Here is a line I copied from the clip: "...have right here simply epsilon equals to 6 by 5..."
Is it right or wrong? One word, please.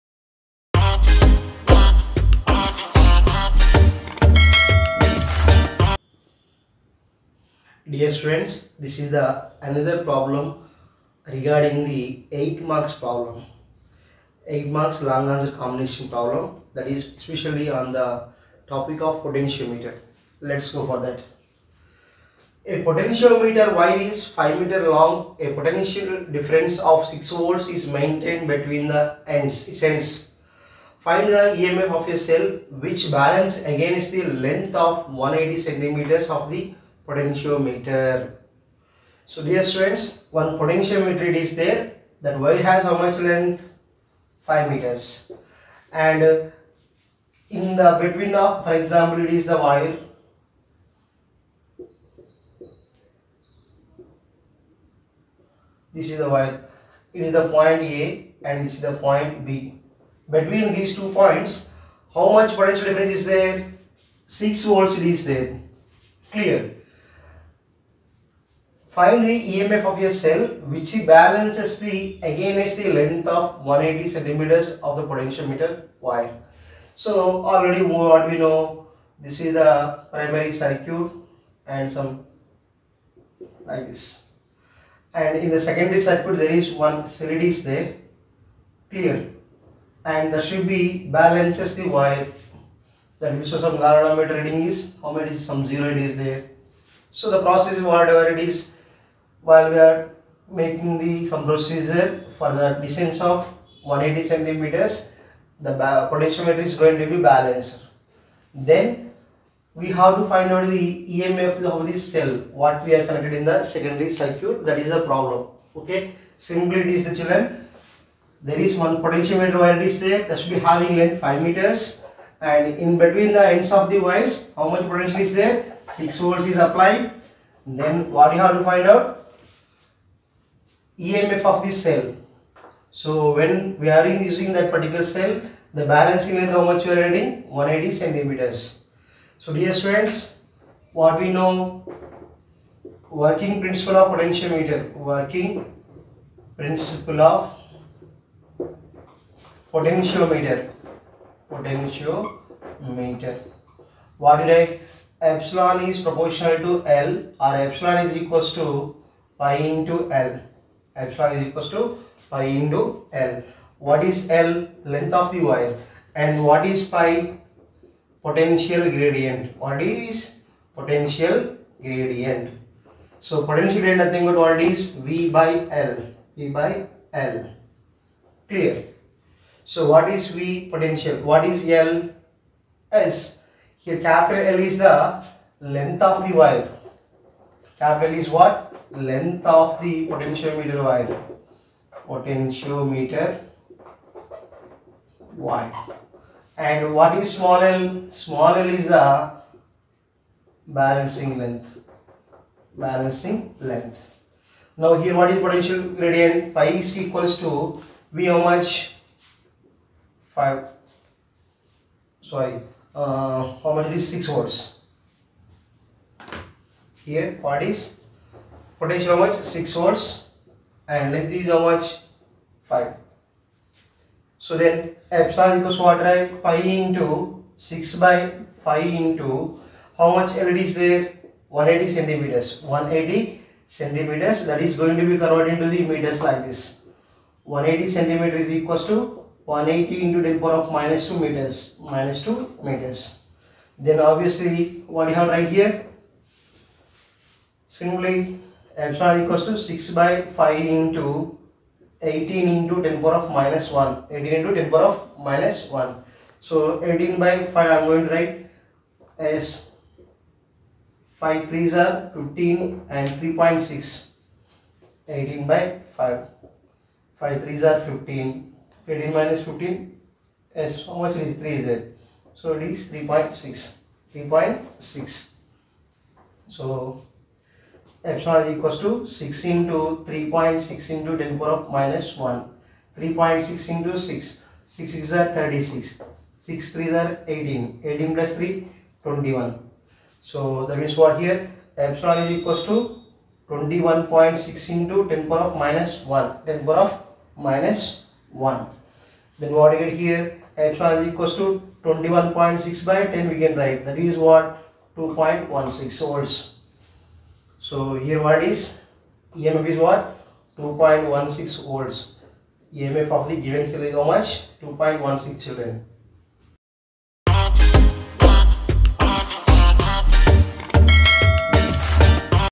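right.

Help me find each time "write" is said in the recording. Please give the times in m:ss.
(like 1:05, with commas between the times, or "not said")
2:34, 4:18, 5:03.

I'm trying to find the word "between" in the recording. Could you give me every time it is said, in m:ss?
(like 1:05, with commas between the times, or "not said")
0:28, 0:48, 1:00, 2:02.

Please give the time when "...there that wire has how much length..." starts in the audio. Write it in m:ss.
0:41.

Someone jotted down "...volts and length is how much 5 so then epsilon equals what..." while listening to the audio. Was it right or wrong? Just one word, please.
right.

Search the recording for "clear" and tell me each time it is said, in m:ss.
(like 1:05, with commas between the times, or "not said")
1:06, 1:28, 2:58.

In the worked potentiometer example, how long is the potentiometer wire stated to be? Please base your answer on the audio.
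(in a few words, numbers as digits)
5 meters.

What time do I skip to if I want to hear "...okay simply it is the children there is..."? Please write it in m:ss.
1:55.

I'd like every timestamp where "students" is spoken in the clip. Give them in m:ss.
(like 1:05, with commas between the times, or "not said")
0:39, 2:19.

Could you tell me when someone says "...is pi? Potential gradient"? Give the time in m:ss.
2:46.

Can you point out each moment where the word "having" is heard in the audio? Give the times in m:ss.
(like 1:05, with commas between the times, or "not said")
2:00.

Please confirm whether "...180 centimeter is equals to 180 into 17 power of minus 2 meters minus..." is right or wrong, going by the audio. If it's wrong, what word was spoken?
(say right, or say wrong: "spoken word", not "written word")
wrong: "10", not "17".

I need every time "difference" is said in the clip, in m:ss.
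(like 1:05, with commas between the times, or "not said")
0:26, 1:02.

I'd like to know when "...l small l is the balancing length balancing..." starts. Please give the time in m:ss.
3:17.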